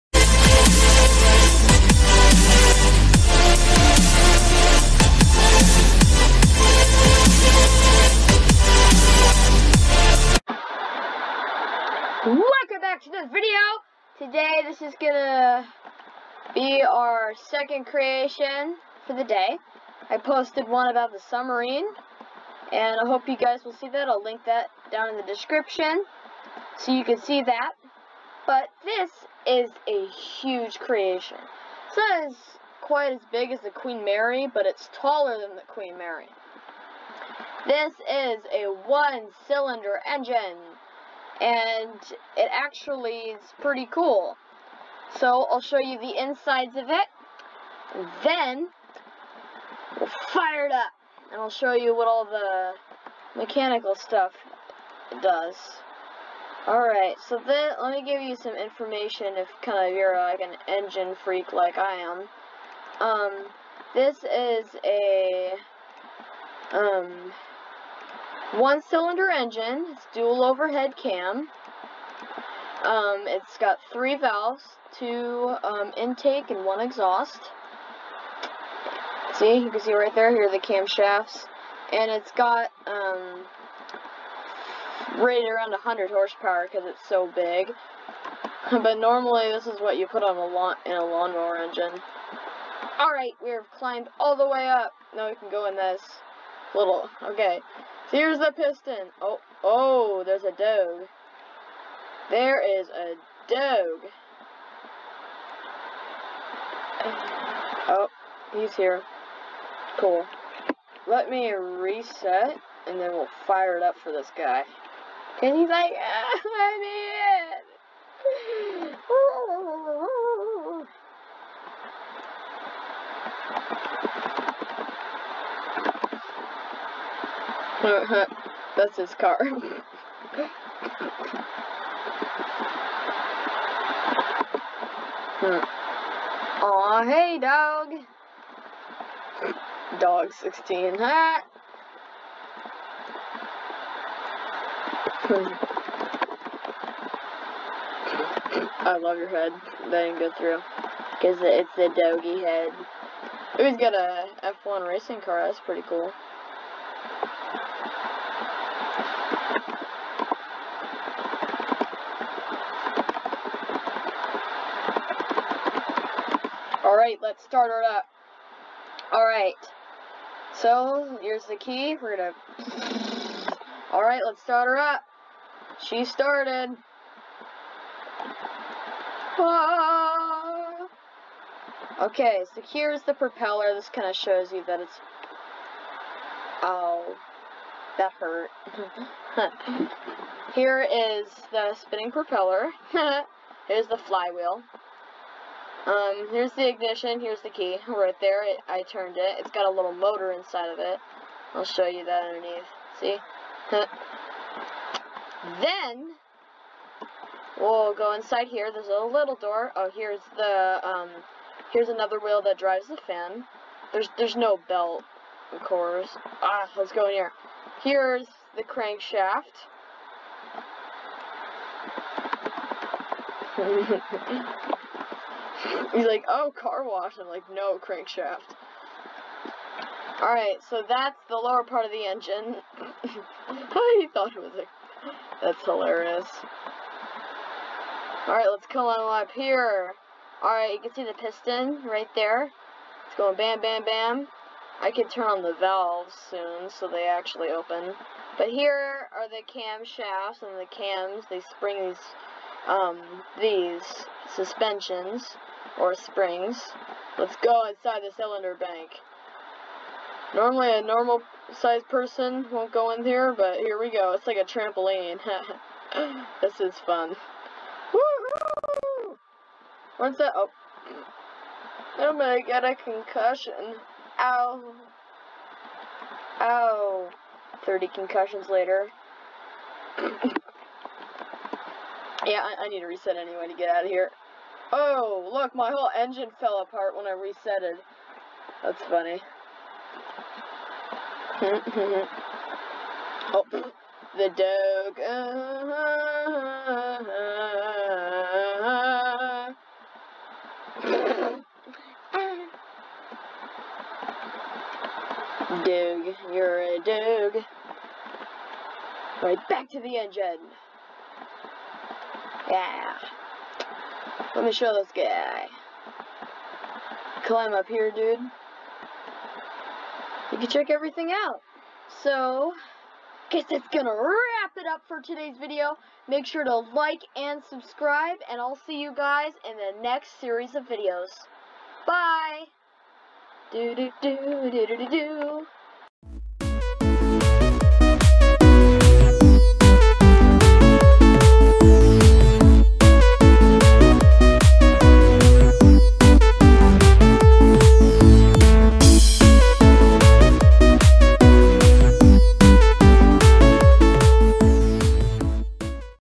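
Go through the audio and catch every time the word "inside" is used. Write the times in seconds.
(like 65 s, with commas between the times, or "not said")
46 s, 200 s, 208 s, 257 s.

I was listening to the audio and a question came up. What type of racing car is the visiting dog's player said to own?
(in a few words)
F1 racing car.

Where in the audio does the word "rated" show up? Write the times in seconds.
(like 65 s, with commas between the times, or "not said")
85 s.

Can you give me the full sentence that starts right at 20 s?
I posted one about the submarine and I hope you guys will see that.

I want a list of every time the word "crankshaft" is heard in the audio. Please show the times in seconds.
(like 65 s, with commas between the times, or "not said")
218 s, 227 s.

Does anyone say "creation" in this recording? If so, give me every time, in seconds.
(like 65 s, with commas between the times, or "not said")
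17 s, 30 s.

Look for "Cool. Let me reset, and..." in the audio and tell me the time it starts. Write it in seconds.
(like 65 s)
109 s.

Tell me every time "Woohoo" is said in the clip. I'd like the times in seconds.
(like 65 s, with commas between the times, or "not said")
267 s.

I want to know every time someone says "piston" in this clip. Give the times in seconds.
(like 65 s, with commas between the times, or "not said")
98 s, 241 s.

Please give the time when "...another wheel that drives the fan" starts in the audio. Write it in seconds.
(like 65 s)
211 s.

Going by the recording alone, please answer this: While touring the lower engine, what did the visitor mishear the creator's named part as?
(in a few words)
Car wash.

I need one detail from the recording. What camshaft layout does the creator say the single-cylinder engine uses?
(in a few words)
Dual overhead cam.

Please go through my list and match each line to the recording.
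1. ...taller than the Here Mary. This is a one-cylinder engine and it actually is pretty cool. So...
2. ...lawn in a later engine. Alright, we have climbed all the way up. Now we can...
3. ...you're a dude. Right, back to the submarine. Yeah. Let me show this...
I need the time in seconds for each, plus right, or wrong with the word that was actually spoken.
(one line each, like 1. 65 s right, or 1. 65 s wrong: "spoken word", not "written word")
1. 34 s wrong: "Queen", not "Here"
2. 90 s wrong: "lawnmower", not "later"
3. 306 s wrong: "engine", not "submarine".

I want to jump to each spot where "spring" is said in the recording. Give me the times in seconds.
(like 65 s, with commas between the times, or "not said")
251 s, 255 s.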